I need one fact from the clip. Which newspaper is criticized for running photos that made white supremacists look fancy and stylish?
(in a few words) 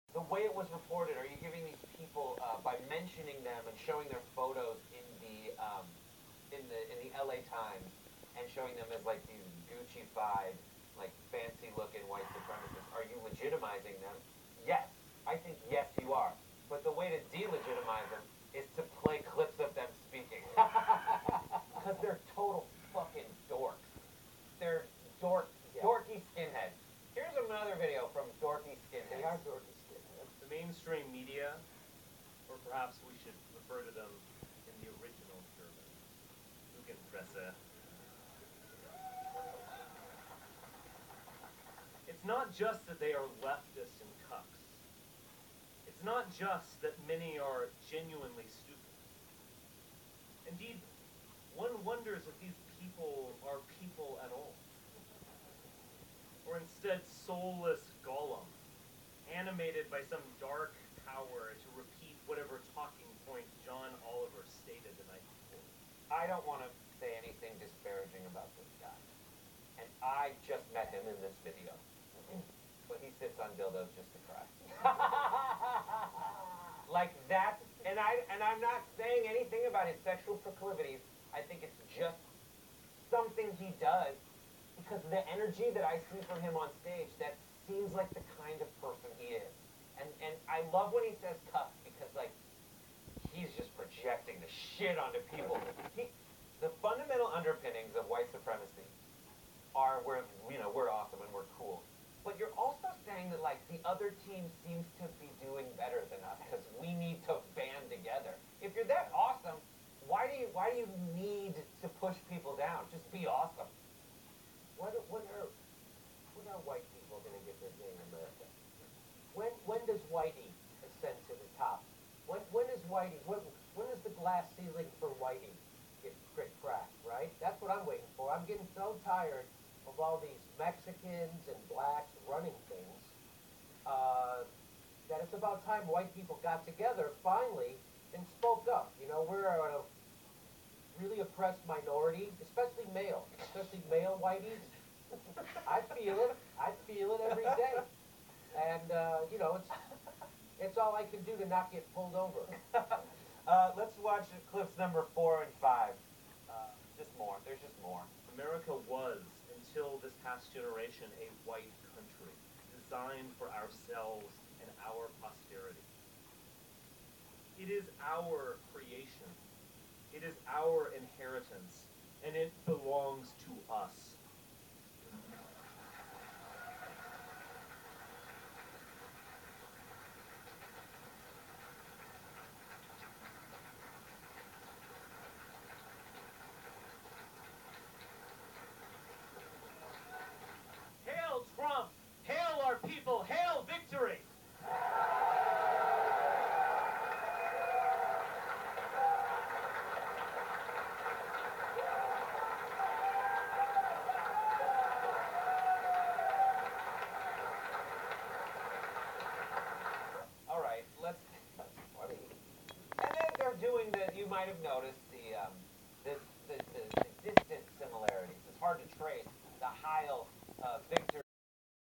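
LA Times.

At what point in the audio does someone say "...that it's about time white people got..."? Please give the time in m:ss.
2:15.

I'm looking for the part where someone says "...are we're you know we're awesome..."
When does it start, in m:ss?
1:39.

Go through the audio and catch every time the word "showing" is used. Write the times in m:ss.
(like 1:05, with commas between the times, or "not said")
0:03, 0:08.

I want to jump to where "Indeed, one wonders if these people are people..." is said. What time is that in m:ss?
0:50.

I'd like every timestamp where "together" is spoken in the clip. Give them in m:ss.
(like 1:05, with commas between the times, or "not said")
1:47, 2:16.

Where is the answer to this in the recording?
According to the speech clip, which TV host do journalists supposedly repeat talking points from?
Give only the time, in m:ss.
1:03.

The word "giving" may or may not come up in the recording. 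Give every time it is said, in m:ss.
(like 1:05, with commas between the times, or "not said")
0:01.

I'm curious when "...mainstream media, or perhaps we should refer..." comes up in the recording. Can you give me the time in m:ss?
0:30.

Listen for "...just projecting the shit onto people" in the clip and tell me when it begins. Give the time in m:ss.
1:33.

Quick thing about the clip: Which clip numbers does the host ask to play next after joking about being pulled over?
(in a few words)
4 and 5.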